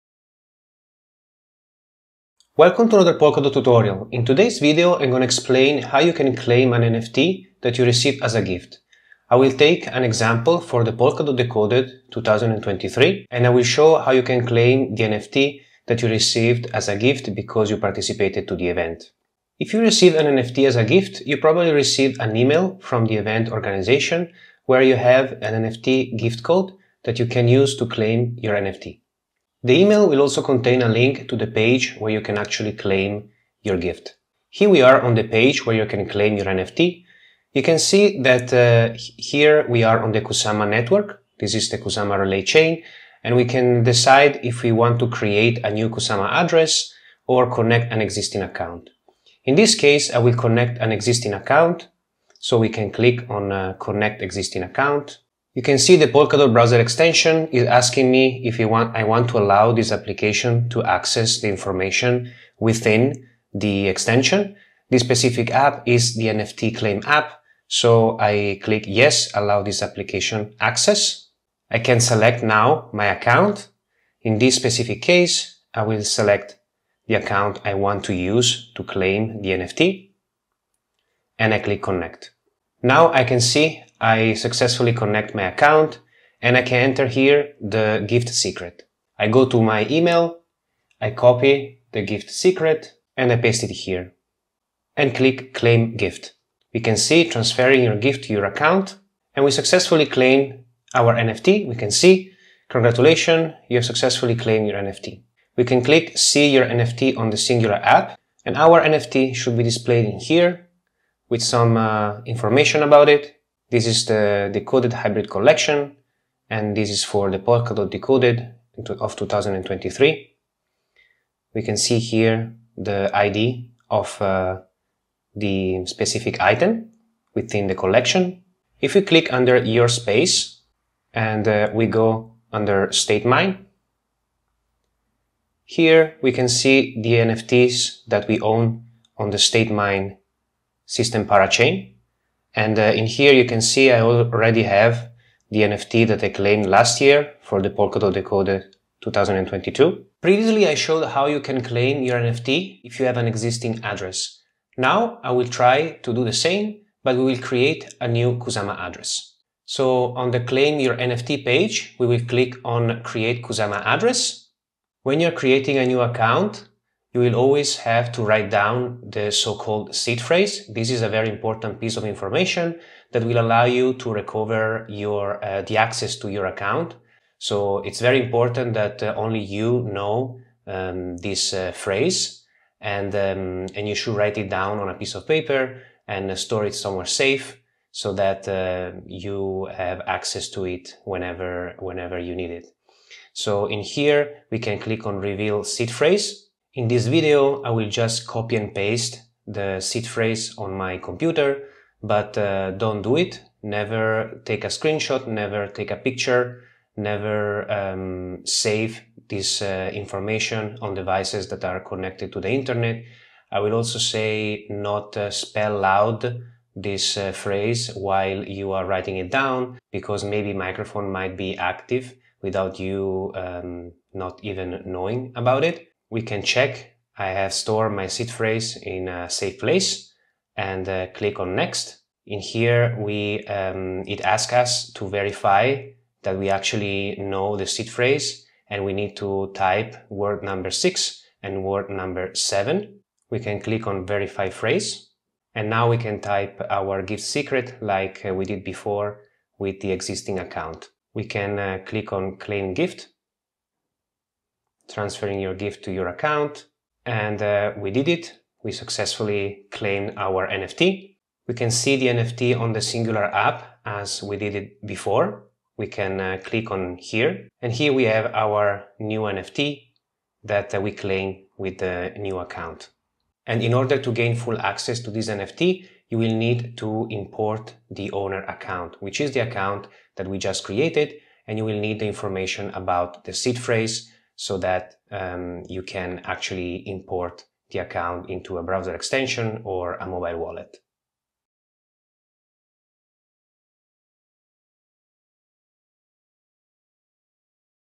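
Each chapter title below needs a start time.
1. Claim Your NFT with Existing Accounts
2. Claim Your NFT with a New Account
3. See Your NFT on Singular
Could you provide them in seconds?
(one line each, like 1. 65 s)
1. 43 s
2. 149 s
3. 105 s.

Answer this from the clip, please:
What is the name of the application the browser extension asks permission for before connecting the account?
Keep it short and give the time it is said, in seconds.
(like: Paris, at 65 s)
NFT claim app, at 66 s.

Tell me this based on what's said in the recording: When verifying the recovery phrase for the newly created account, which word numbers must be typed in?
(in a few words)
6 and 7.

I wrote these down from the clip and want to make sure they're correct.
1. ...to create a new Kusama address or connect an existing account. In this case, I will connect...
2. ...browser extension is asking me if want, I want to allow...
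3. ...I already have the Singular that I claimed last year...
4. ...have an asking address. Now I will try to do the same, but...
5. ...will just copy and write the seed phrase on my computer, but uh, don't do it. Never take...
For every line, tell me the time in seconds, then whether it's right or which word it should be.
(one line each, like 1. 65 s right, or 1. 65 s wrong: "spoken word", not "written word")
1. 44 s right
2. 56 s right
3. 143 s wrong: "NFT", not "Singular"
4. 153 s wrong: "existing", not "asking"
5. 197 s wrong: "paste", not "write".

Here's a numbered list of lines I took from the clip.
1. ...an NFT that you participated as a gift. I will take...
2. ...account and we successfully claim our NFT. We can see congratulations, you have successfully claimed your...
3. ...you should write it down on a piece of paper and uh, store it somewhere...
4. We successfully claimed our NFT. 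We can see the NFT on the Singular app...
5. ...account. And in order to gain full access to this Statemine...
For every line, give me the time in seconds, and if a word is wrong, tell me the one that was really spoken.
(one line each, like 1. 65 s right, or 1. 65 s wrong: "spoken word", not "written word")
1. 6 s wrong: "received", not "participated"
2. 98 s right
3. 183 s right
4. 258 s right
5. 272 s wrong: "NFT", not "Statemine".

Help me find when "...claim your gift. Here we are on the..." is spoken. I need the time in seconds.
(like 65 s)
32 s.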